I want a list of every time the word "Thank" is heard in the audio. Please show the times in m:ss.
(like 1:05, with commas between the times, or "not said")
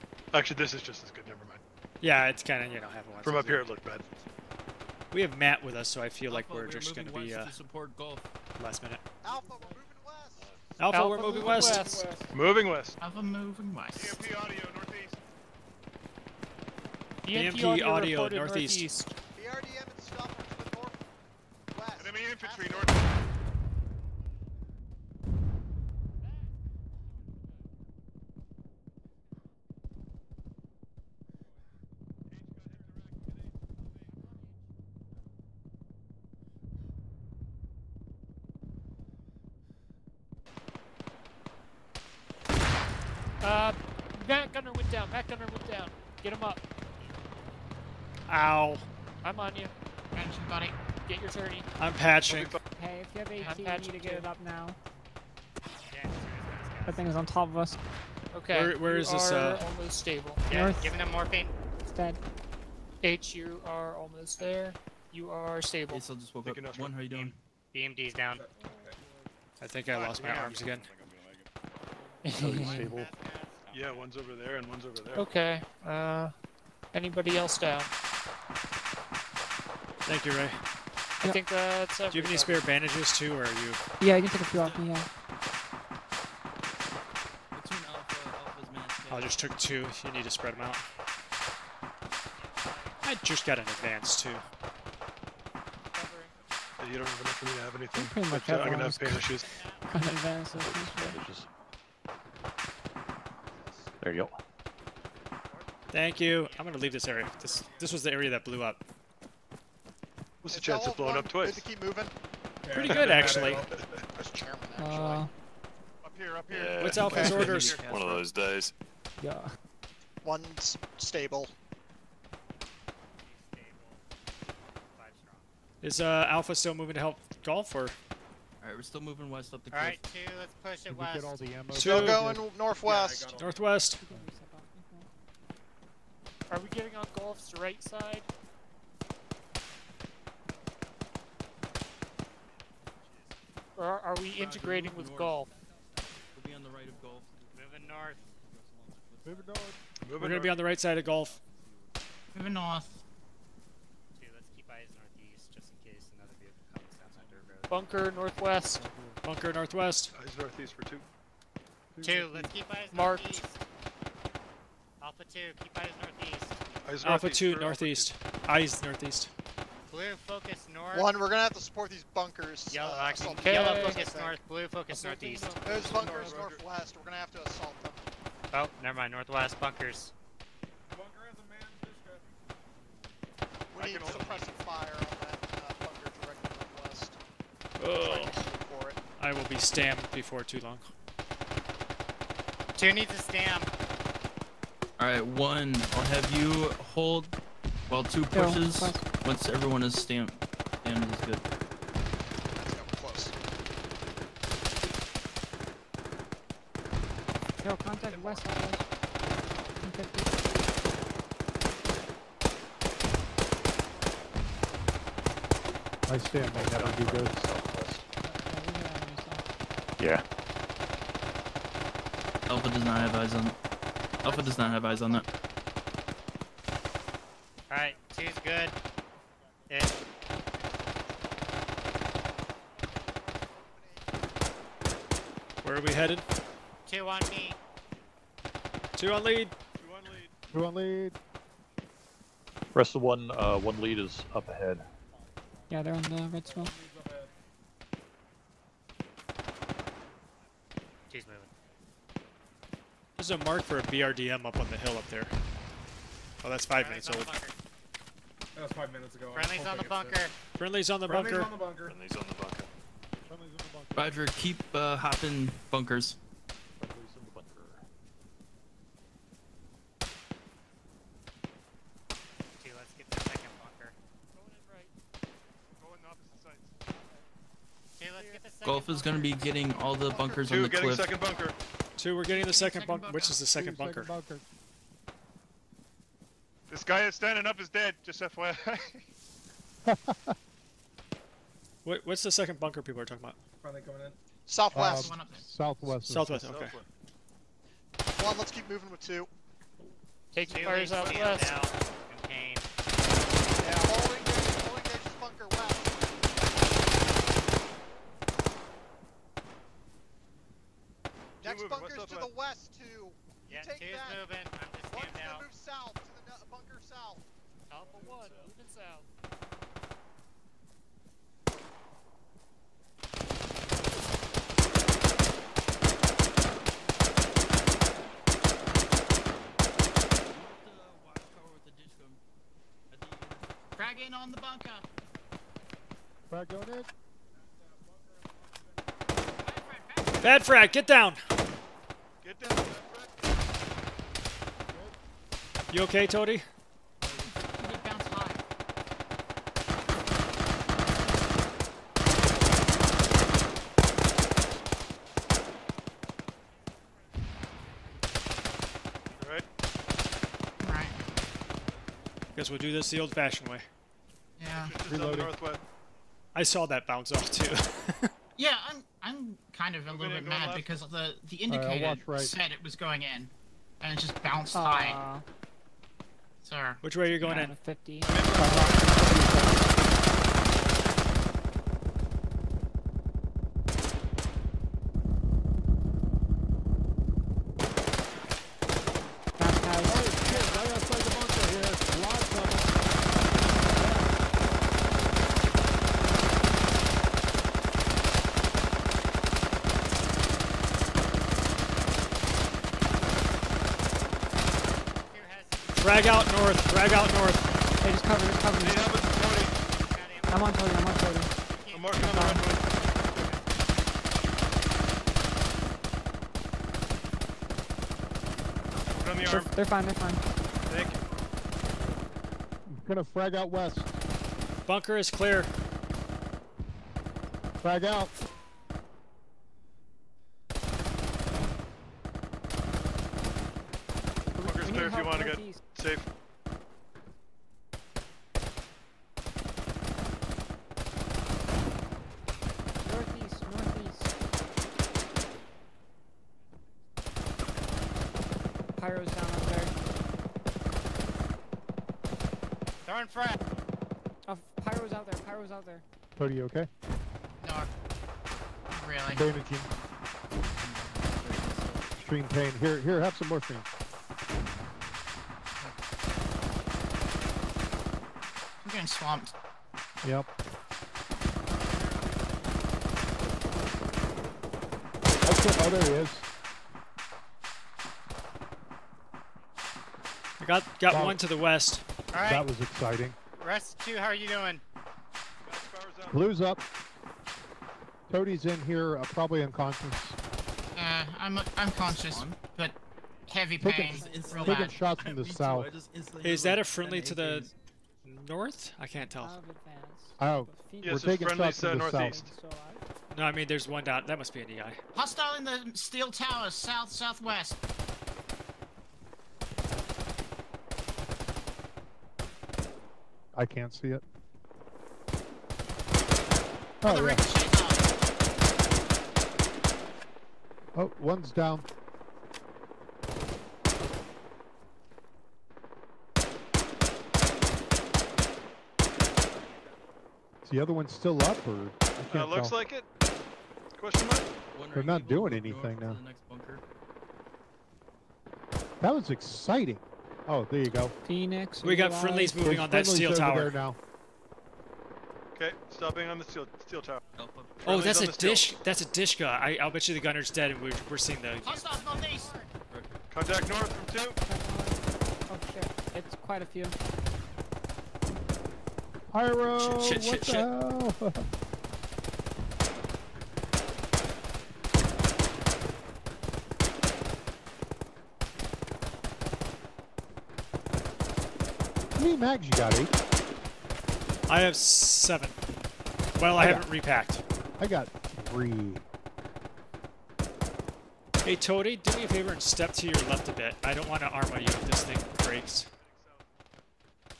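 1:20, 1:45, 7:00.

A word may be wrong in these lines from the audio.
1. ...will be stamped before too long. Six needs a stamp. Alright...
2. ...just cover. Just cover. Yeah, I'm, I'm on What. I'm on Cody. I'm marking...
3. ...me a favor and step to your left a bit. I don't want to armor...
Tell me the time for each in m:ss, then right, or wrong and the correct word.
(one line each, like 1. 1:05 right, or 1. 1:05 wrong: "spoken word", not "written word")
1. 3:09 wrong: "Two", not "Six"
2. 6:47 wrong: "Cody", not "What"
3. 9:41 right.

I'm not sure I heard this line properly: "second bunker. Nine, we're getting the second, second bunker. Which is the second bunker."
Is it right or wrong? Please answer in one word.
wrong.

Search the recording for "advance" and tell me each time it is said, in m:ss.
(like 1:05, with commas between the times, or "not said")
1:33, 1:39.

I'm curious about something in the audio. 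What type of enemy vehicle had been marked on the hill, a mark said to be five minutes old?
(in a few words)
BRDM.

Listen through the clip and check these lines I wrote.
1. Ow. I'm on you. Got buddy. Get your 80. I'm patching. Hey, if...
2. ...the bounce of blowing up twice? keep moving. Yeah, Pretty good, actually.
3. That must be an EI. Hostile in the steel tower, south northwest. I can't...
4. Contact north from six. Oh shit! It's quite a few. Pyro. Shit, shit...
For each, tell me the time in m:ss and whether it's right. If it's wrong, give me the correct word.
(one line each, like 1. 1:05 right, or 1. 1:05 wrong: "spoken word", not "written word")
1. 0:48 wrong: "30", not "80"
2. 1:50 wrong: "chance", not "bounce"
3. 8:24 wrong: "southwest", not "northwest"
4. 9:13 wrong: "two", not "six".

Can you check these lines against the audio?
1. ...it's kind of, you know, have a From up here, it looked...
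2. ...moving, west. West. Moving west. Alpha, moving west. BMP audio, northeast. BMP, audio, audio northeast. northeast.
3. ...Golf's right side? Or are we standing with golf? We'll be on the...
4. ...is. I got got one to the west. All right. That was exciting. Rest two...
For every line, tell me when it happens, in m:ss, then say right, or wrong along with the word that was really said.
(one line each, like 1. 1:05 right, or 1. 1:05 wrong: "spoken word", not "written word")
1. 0:02 right
2. 0:11 right
3. 2:17 wrong: "integrating", not "standing"
4. 7:56 right.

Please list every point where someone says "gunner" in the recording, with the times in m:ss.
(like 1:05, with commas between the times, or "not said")
0:44, 9:09.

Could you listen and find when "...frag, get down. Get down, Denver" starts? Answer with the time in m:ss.
5:40.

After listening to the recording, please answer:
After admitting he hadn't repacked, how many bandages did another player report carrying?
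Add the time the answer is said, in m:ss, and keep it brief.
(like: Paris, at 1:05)
3, at 9:37.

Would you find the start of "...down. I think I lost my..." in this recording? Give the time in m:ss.
1:08.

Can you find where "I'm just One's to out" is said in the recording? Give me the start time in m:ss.
5:14.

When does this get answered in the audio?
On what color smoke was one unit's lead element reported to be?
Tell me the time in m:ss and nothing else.
4:06.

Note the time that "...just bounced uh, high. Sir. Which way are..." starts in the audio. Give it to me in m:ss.
6:14.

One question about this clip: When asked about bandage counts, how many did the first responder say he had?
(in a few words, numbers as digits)
7.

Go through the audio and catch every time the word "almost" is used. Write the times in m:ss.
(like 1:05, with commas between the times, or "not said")
0:59, 1:03.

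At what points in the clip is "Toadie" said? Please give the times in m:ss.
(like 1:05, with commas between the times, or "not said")
5:46, 8:08, 9:41.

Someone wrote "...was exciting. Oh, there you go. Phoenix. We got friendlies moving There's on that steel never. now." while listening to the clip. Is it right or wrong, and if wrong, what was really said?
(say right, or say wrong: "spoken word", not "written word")
wrong: "tower", not "never".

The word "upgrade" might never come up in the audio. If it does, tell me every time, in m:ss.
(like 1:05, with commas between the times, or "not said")
not said.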